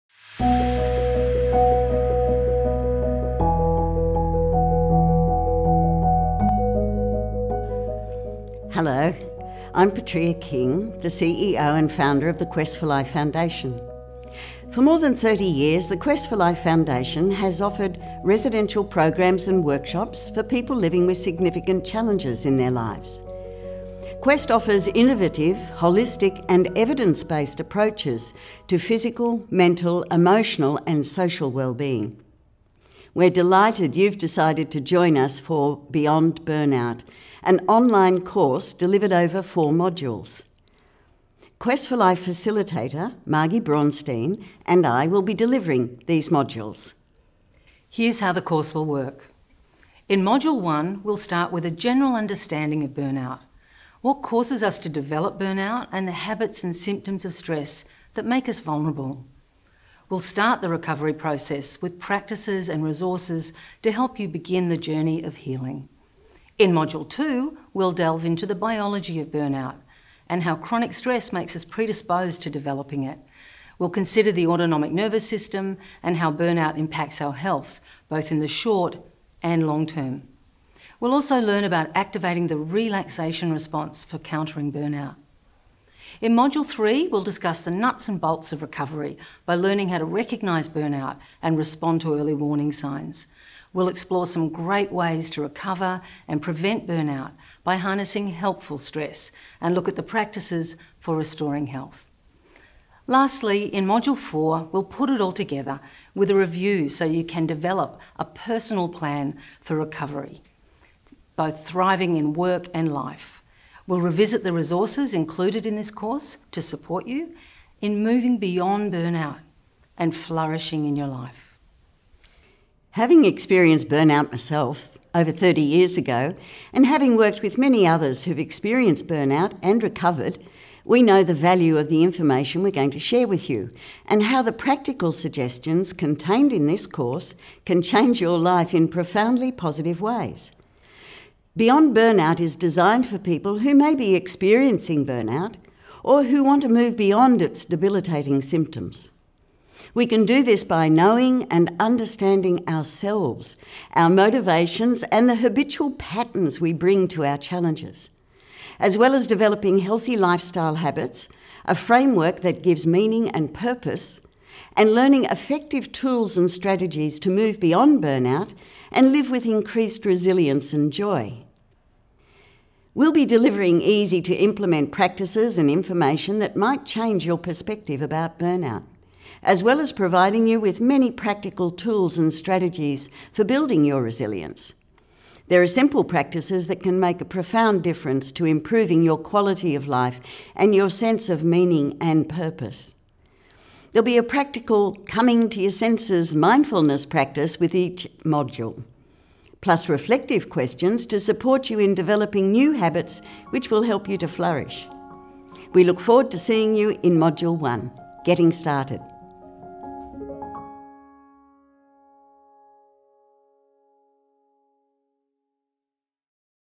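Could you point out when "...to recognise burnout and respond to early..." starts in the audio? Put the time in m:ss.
1:29.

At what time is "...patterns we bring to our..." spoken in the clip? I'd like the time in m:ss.
2:35.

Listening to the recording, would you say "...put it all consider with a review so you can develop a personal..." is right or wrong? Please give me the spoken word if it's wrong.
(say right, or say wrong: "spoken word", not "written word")
wrong: "together", not "consider".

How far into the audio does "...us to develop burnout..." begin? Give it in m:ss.
0:54.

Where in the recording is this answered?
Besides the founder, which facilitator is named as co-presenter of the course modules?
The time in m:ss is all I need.
0:43.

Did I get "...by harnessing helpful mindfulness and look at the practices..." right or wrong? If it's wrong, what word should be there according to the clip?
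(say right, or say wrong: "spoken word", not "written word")
wrong: "stress", not "mindfulness".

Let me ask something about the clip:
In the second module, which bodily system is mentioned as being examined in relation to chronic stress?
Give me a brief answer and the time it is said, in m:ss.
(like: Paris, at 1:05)
autonomic nervous system, at 1:14.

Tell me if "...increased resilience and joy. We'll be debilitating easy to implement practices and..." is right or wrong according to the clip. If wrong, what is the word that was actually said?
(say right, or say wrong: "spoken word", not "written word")
wrong: "delivering", not "debilitating".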